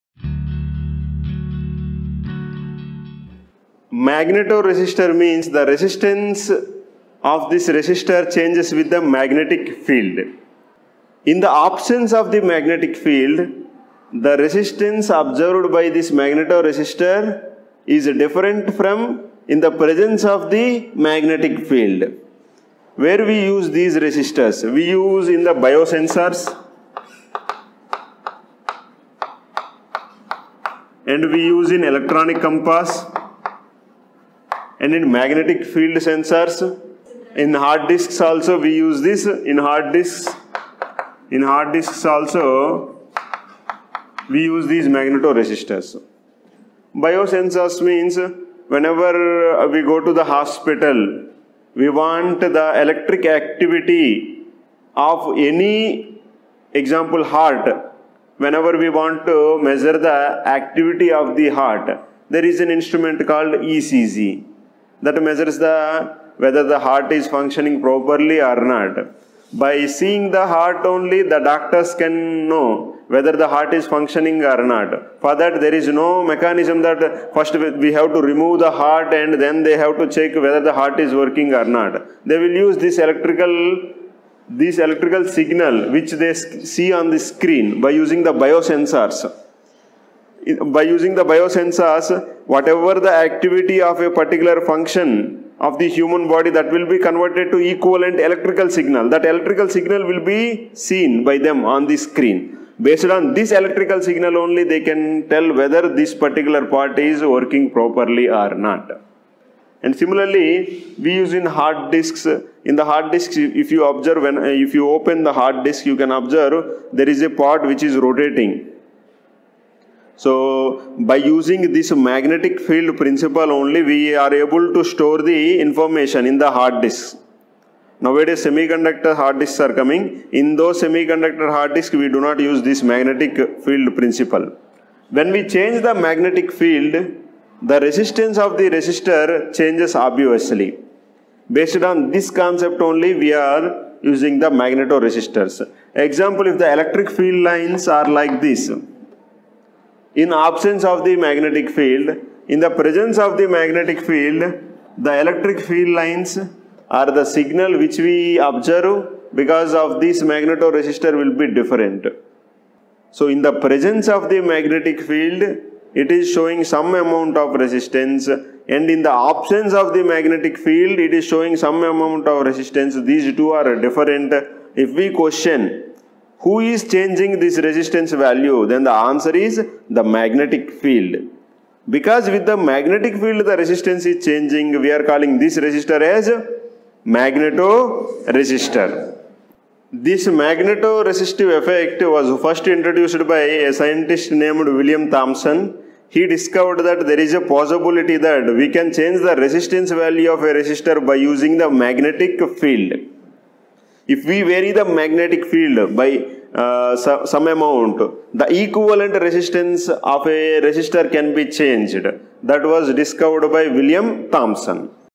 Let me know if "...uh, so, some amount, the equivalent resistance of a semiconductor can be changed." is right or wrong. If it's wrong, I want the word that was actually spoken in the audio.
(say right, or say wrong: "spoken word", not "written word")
wrong: "resistor", not "semiconductor".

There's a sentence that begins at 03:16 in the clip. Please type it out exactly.
He discovered that there is a possibility that we can change the resistance value of a resistor by using the magnetic field.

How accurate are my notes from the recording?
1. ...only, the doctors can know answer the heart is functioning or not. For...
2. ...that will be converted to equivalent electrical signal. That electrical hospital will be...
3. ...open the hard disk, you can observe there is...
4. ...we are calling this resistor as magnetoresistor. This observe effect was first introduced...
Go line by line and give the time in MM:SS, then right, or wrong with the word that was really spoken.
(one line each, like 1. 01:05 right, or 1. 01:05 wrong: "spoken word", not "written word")
1. 01:10 wrong: "whether", not "answer"
2. 01:36 wrong: "signal", not "hospital"
3. 01:54 right
4. 03:04 wrong: "magnetoresistive", not "observe".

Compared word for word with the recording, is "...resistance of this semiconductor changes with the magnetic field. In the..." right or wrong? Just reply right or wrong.
wrong.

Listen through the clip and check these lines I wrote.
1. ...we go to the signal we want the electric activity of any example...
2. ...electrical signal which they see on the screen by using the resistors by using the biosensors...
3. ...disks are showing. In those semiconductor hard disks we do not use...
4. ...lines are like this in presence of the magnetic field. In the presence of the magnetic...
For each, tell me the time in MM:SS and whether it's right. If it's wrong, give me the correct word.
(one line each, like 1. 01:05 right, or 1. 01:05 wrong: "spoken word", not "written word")
1. 00:49 wrong: "hospital", not "signal"
2. 01:24 wrong: "biosensors", not "resistors"
3. 02:09 wrong: "coming", not "showing"
4. 02:27 wrong: "absence", not "presence".